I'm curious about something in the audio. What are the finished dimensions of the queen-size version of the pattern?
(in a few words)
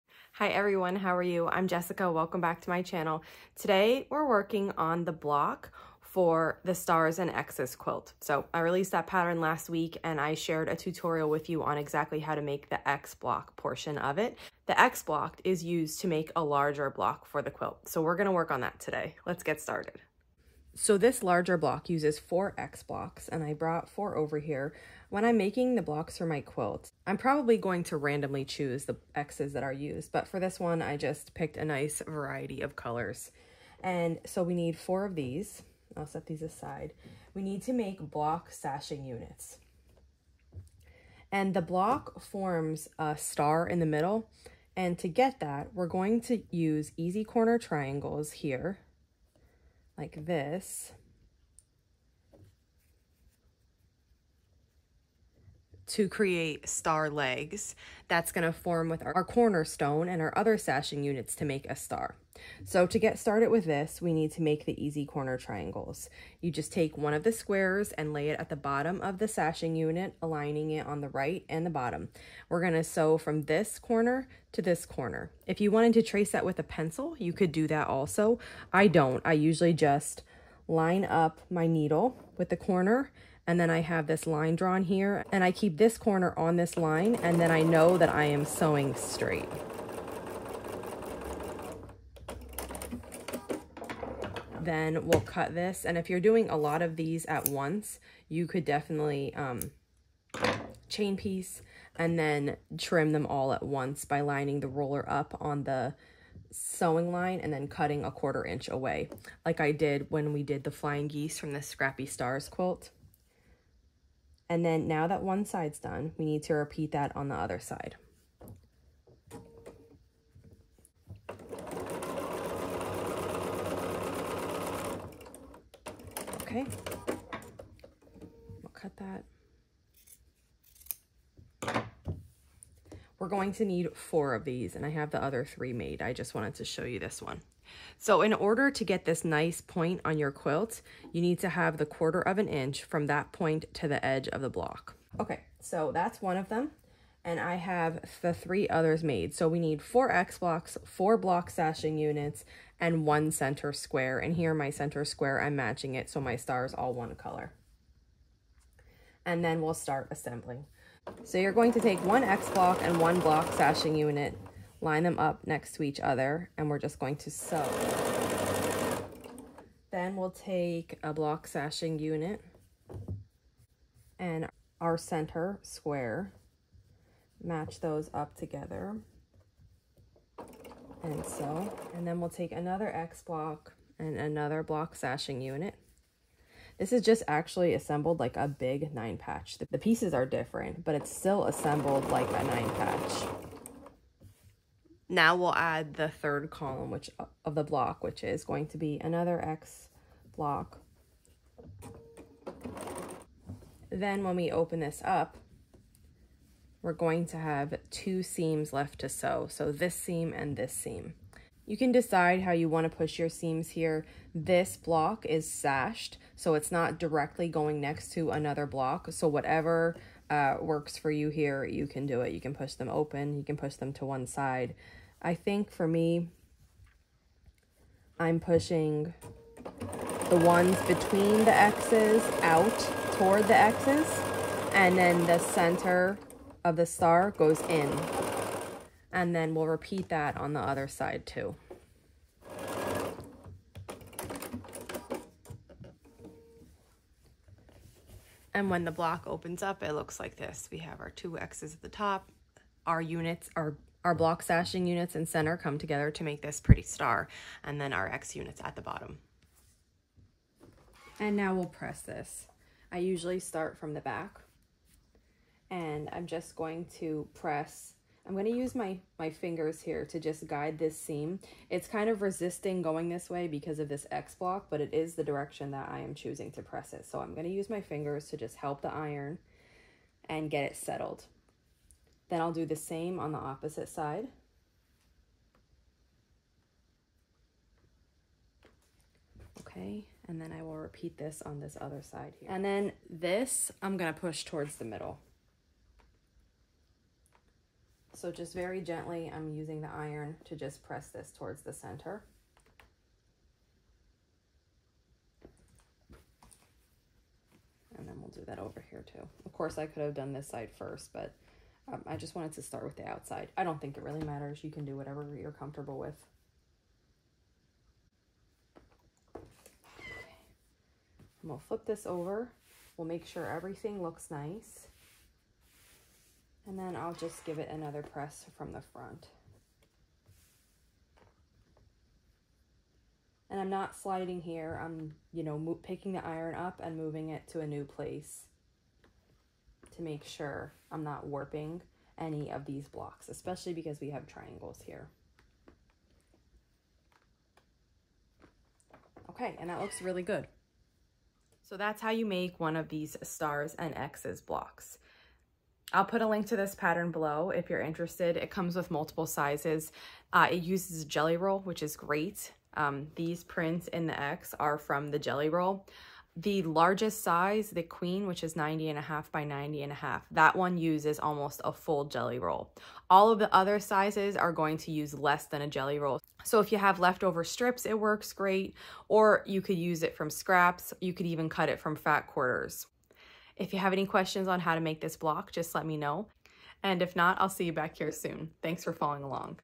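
90 1/2 by 90 1/2.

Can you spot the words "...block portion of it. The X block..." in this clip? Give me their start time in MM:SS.
00:13.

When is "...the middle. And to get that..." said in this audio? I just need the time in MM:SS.
00:43.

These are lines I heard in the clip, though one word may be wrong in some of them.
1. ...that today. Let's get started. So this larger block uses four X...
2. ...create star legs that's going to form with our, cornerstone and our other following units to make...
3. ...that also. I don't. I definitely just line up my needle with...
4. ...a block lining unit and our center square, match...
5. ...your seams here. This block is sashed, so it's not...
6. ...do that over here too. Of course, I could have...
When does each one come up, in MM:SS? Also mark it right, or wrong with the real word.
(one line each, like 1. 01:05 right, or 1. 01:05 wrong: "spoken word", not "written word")
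1. 00:18 right
2. 00:56 wrong: "sashing", not "following"
3. 01:17 wrong: "usually", not "definitely"
4. 02:51 wrong: "sashing", not "lining"
5. 03:33 right
6. 05:08 right.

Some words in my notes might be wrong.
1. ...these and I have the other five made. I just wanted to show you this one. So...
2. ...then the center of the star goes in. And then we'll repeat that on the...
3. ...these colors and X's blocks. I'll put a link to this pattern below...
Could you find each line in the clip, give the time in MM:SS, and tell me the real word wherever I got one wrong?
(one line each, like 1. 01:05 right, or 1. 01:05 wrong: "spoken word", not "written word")
1. 02:14 wrong: "three", not "five"
2. 03:54 right
3. 05:52 wrong: "stars", not "colors".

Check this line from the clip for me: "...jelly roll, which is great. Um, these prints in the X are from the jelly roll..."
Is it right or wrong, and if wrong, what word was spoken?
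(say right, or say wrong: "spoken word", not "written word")
right.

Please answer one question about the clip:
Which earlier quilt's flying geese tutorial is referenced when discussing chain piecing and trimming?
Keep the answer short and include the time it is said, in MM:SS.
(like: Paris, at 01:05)
Scrappy Stars, at 01:51.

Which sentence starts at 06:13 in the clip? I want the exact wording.
All of the other sizes are going to use less than a jelly roll.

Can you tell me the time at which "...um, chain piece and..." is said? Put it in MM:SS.
01:39.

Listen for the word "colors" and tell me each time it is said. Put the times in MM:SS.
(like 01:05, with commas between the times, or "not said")
00:32, 02:37.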